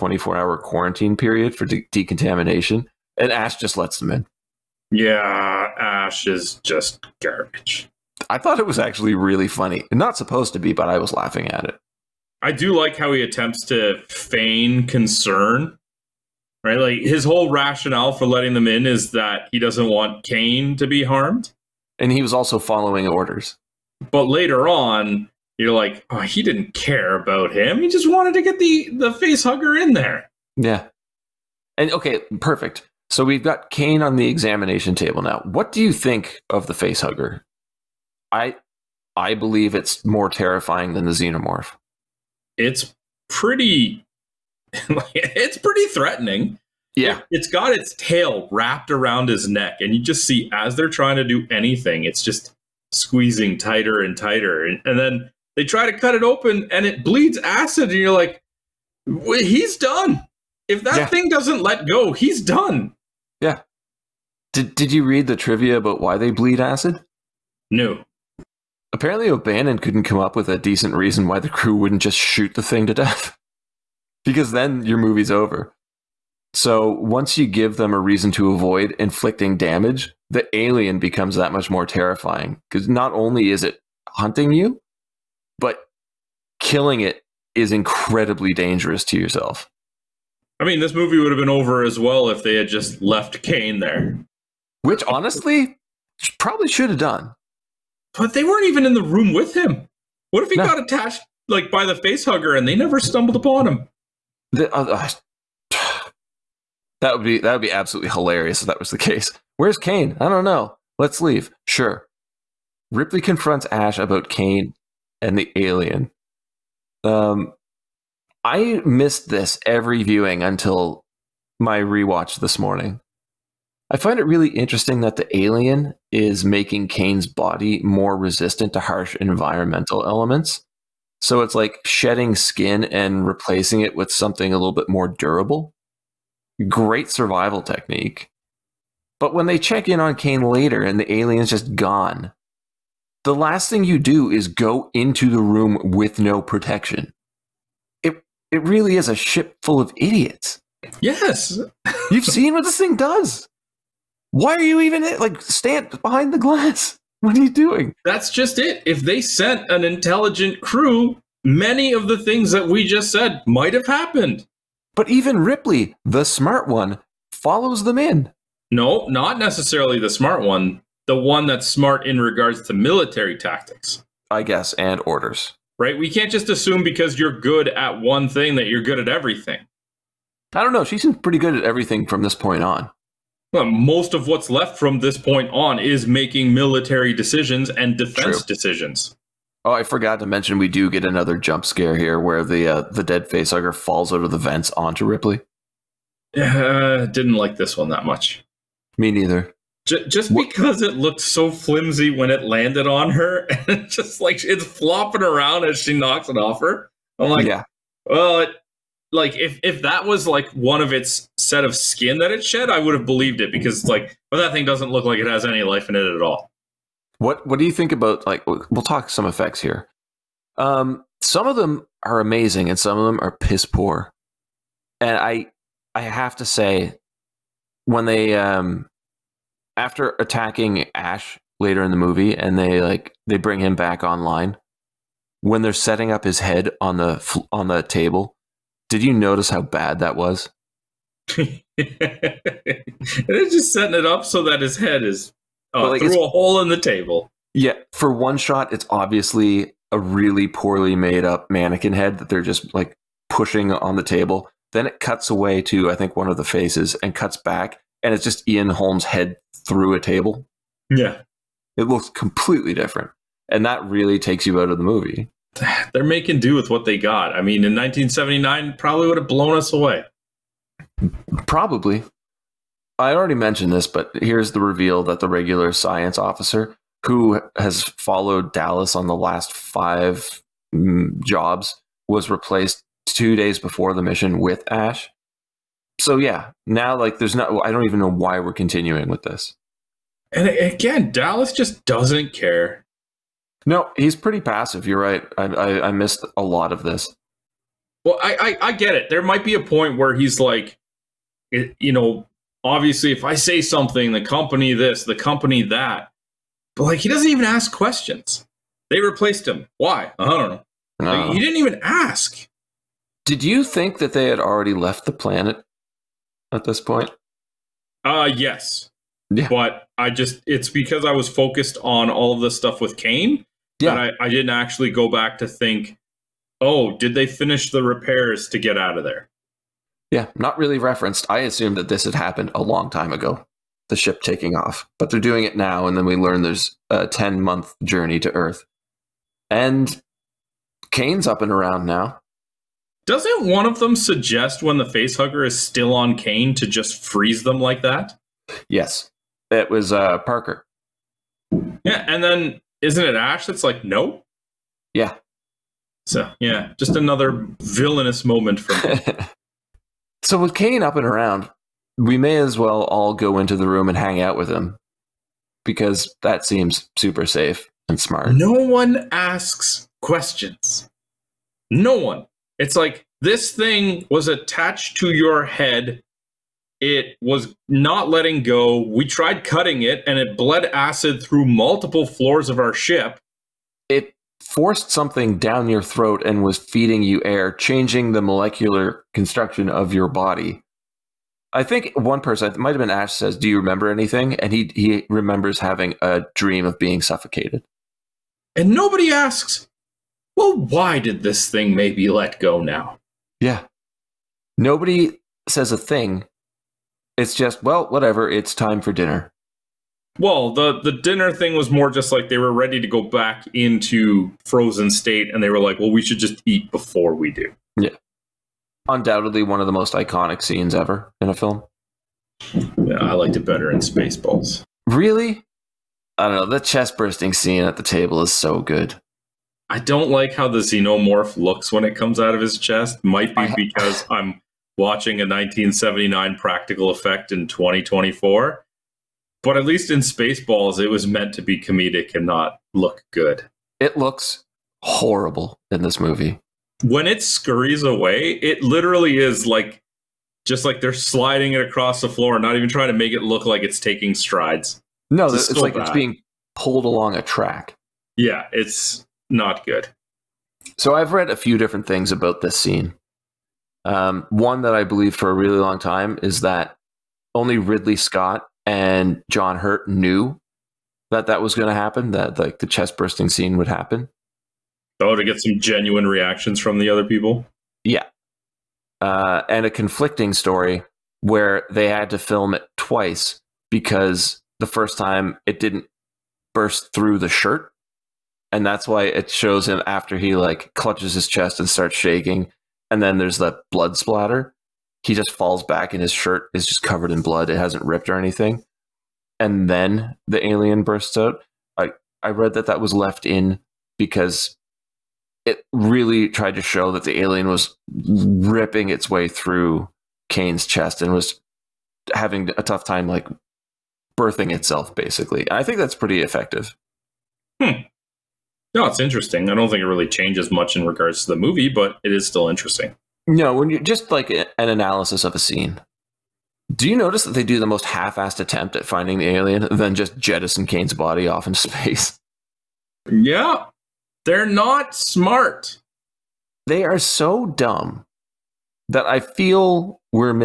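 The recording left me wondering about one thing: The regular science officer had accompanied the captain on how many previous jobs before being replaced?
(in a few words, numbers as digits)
5.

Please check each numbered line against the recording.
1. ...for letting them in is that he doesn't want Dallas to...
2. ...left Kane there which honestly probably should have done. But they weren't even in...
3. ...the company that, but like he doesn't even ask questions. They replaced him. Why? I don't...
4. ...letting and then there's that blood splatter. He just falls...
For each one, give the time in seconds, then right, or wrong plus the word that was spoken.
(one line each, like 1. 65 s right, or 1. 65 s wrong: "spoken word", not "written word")
1. 18 s wrong: "Kane", not "Dallas"
2. 93 s right
3. 305 s right
4. 491 s wrong: "shaking", not "letting".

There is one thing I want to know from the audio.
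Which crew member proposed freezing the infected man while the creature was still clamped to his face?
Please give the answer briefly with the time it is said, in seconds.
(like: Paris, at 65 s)
Parker, at 350 s.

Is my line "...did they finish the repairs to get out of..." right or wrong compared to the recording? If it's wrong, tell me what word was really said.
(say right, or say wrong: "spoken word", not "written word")
right.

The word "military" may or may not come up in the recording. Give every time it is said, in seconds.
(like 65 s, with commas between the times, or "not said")
172 s, 186 s.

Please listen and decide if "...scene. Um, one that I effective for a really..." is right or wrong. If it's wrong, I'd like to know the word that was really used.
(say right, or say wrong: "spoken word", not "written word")
wrong: "believe", not "effective".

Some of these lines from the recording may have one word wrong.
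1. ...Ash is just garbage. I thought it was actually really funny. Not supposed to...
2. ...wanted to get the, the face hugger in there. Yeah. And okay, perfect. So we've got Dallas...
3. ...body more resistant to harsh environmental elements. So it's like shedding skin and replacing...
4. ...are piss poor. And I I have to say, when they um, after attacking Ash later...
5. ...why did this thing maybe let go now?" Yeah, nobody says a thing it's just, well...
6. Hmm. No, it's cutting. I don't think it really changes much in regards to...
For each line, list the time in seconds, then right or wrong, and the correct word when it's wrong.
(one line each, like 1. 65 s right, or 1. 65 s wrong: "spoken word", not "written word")
1. 5 s right
2. 28 s wrong: "Kane", not "Dallas"
3. 127 s right
4. 223 s right
5. 400 s right
6. 517 s wrong: "interesting", not "cutting".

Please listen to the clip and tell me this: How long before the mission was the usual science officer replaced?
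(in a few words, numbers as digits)
2 days.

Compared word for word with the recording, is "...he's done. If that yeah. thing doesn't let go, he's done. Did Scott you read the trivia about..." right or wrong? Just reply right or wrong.
wrong.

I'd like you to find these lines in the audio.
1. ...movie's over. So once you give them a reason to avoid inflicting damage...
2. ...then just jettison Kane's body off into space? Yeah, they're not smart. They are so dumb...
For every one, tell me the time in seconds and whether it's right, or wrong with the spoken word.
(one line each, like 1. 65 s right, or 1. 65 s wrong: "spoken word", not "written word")
1. 74 s right
2. 529 s right.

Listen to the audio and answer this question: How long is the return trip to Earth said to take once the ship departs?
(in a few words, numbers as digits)
10 months.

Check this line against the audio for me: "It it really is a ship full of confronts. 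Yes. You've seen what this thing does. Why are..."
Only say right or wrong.
wrong.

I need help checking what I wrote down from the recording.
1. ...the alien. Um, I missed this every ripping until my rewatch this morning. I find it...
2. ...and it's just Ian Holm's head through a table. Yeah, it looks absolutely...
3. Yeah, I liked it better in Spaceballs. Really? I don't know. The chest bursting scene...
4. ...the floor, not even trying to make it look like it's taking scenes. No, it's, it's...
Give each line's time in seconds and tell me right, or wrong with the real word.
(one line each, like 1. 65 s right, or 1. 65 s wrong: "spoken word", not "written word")
1. 115 s wrong: "viewing", not "ripping"
2. 258 s wrong: "completely", not "absolutely"
3. 422 s right
4. 452 s wrong: "strides", not "scenes".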